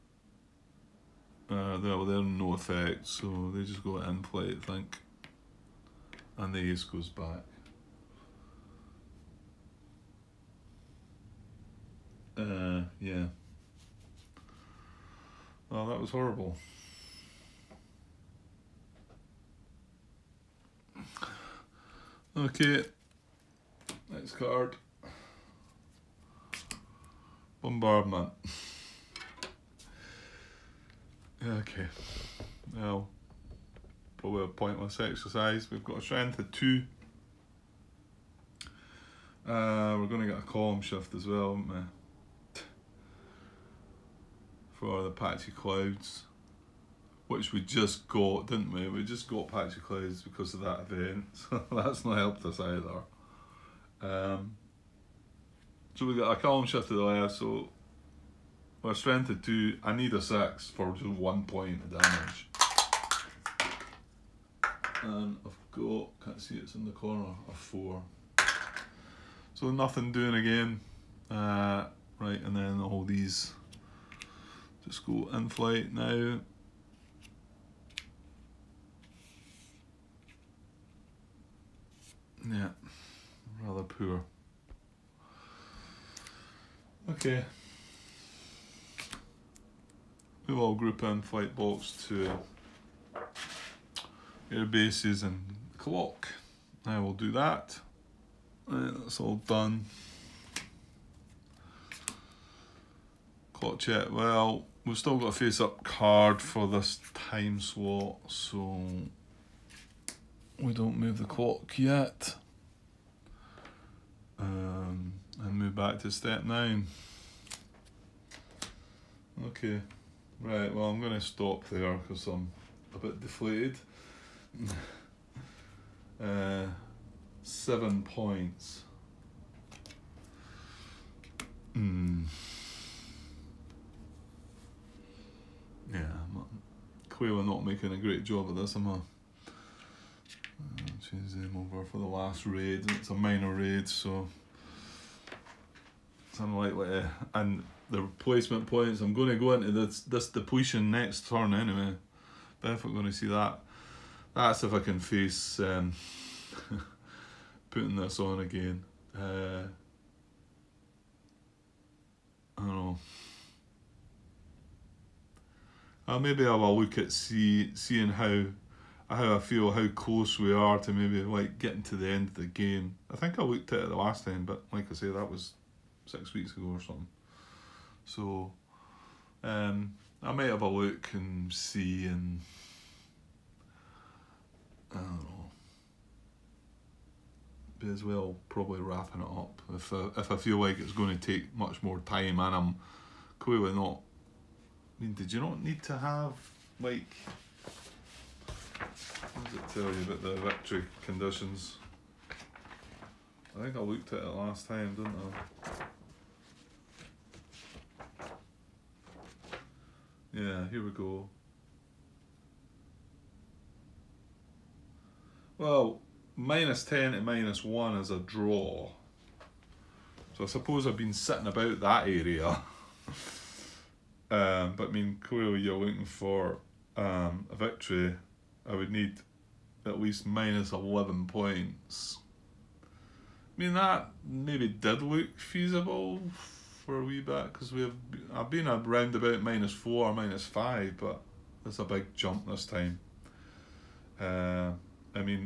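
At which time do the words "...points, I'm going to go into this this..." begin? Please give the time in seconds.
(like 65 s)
148 s.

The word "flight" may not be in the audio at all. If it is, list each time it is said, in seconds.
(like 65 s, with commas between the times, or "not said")
3 s, 75 s, 91 s.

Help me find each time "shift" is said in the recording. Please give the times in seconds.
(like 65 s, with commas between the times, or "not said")
40 s, 56 s.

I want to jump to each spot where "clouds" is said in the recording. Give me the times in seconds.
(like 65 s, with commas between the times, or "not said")
45 s, 49 s.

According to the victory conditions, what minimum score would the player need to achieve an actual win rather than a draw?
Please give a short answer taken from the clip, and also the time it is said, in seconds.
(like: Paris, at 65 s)
-11, at 230 s.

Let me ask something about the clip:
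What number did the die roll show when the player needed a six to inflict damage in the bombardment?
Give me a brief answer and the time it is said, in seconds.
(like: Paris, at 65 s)
4, at 67 s.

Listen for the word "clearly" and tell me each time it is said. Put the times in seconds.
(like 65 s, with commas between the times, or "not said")
193 s, 225 s.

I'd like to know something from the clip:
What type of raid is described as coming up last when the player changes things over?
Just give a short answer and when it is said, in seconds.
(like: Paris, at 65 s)
minor raid, at 143 s.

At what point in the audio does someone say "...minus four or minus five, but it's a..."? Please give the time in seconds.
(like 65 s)
239 s.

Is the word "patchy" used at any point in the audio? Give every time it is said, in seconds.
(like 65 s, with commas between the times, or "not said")
45 s, 49 s.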